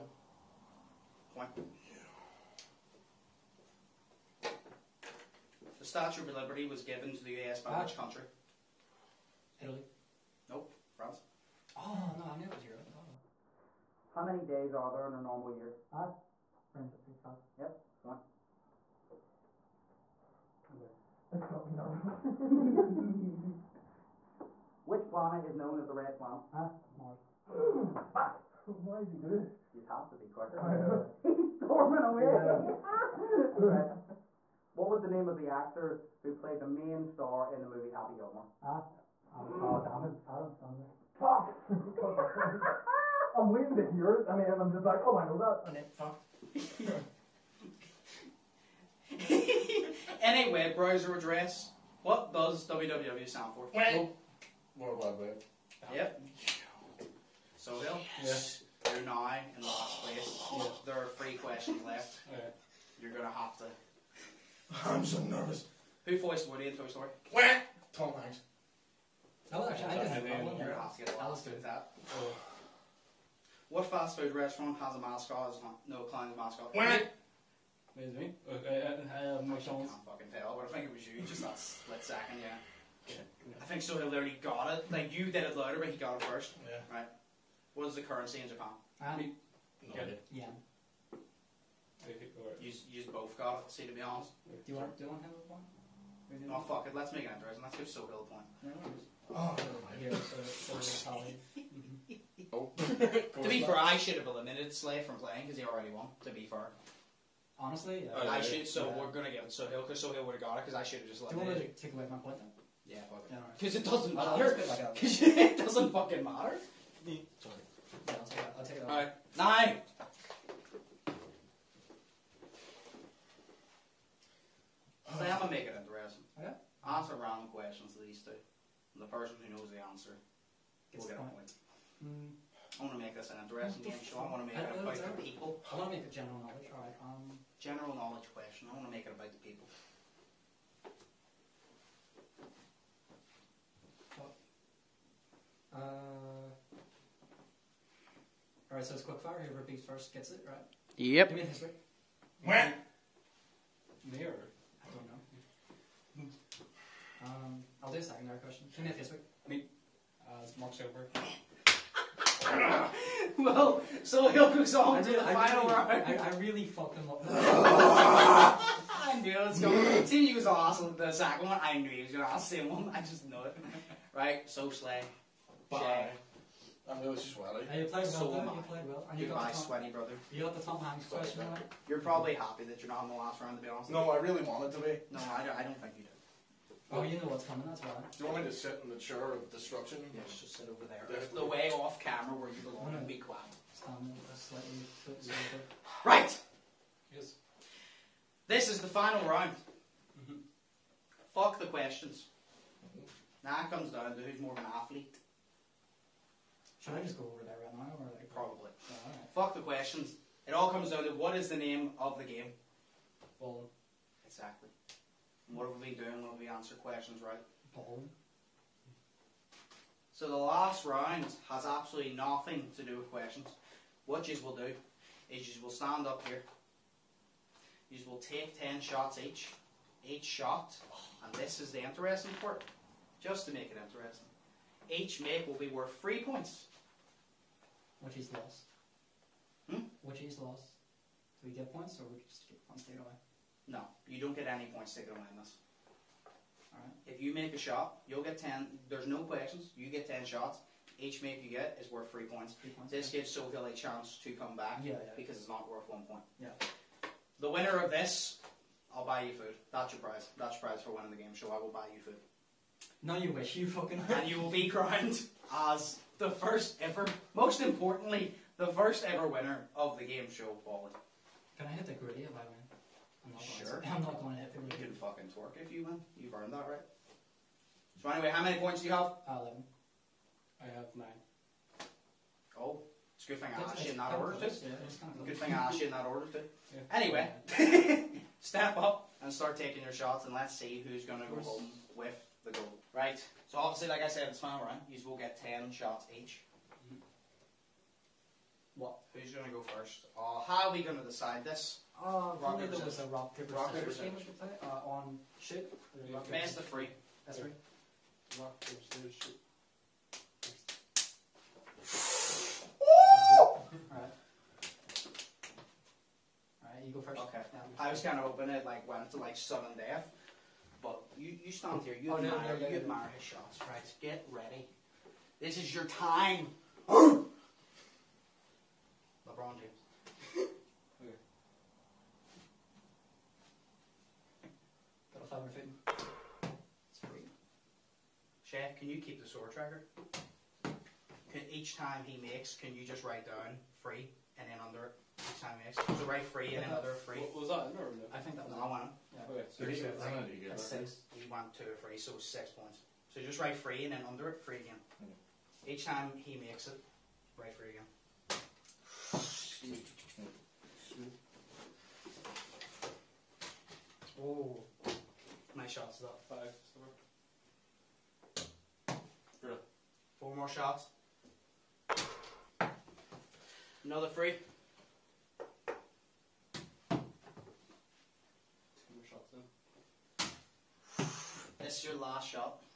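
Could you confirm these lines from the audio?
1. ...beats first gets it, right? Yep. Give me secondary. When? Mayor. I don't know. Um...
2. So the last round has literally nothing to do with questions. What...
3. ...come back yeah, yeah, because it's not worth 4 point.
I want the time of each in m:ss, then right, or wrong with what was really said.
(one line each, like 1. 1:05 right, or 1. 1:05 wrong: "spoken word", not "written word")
1. 2:29 wrong: "history", not "secondary"
2. 3:40 wrong: "absolutely", not "literally"
3. 4:14 wrong: "1", not "4".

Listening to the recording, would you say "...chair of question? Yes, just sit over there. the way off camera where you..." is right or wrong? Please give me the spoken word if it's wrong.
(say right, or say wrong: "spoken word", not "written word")
wrong: "destruction", not "question".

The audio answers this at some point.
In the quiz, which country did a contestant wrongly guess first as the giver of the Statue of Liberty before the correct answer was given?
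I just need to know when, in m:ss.
0:09.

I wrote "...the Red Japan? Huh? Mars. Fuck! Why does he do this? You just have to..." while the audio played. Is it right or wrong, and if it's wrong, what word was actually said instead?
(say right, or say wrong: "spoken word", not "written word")
wrong: "Planet", not "Japan".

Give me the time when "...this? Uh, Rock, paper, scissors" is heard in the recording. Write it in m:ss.
5:01.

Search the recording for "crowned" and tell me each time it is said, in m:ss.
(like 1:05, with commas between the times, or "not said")
4:24.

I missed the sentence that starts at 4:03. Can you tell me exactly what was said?
No, you don't get any points taken away in this.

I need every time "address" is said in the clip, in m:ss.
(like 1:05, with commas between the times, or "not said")
0:51.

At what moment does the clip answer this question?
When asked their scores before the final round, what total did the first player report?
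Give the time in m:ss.
4:39.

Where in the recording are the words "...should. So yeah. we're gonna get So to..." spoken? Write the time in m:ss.
1:48.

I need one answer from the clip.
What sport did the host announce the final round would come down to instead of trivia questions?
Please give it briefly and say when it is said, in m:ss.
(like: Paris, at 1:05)
Bowling, at 3:33.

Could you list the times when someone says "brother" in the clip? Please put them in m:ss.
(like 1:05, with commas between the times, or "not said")
2:59.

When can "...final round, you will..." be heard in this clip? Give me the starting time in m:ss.
4:54.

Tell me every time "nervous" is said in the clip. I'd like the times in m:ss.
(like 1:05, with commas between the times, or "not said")
0:21, 1:05.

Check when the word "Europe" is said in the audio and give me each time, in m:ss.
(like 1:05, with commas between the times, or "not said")
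0:12.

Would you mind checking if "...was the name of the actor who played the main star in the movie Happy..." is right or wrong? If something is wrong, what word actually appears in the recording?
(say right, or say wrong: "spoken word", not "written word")
right.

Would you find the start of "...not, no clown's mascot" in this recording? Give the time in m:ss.
1:15.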